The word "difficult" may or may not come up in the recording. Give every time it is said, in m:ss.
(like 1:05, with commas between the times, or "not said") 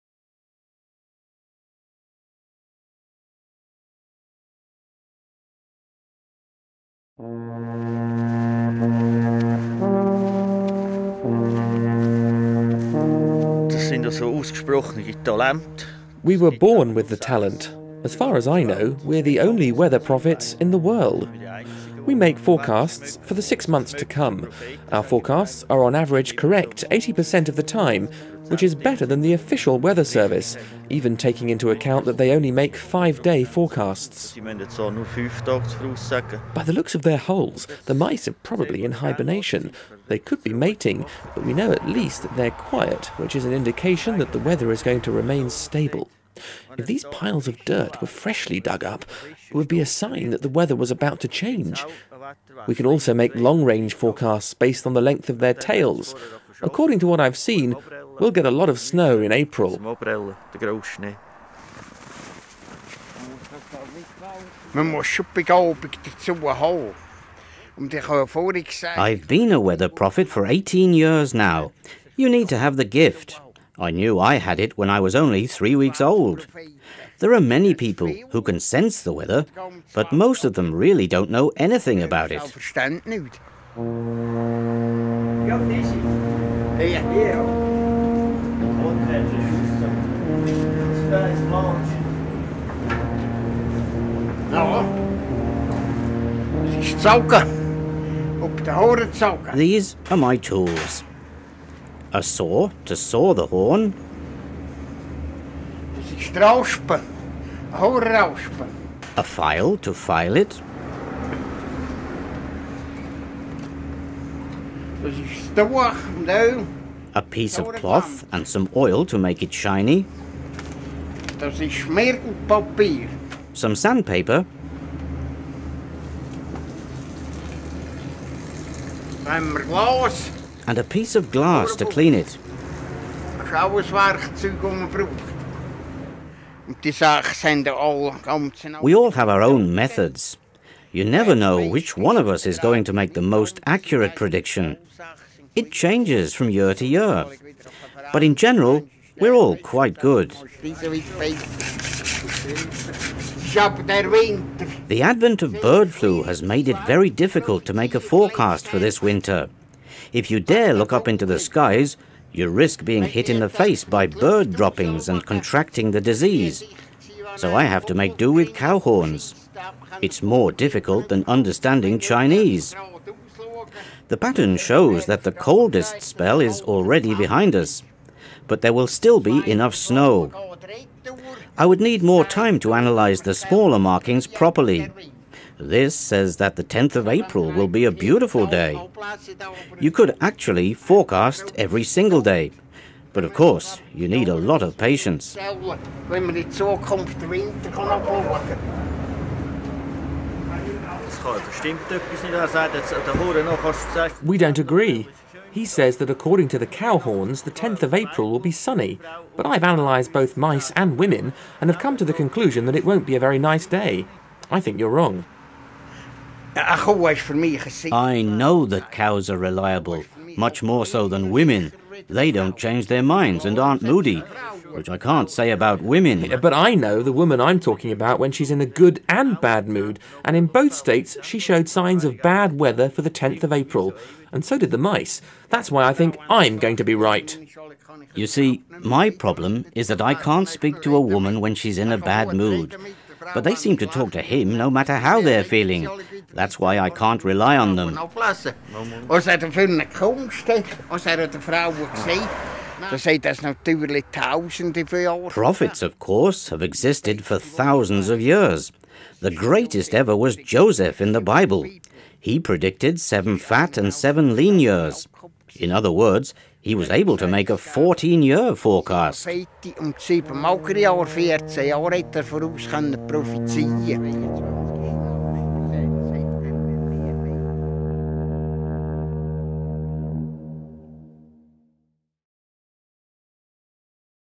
2:37, 2:50.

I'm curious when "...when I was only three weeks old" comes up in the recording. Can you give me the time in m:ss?
1:14.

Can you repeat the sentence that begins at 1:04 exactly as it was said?
Um, I've been a weather prophet for 18 years now.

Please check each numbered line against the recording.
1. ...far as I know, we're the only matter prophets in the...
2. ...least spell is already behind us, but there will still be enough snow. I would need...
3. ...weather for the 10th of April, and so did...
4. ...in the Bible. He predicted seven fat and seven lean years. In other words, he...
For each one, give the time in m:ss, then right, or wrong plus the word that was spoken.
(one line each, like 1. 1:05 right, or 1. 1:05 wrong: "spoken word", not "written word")
1. 0:18 wrong: "weather", not "matter"
2. 2:55 wrong: "coldest", not "least"
3. 3:52 right
4. 4:21 right.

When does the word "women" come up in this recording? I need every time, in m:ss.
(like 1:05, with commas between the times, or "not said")
3:30, 3:41, 3:45.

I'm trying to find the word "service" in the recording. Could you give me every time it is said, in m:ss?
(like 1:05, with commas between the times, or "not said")
0:30.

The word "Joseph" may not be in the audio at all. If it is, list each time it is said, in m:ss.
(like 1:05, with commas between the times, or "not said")
4:20.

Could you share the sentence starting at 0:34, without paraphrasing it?
By the looks of their holes, the mice are probably in hibernation.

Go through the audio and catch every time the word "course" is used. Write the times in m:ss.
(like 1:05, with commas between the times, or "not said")
3:13, 4:15.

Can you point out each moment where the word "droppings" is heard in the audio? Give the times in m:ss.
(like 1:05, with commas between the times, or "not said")
2:44.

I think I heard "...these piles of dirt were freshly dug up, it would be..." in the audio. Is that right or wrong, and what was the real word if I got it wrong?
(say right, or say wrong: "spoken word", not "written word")
right.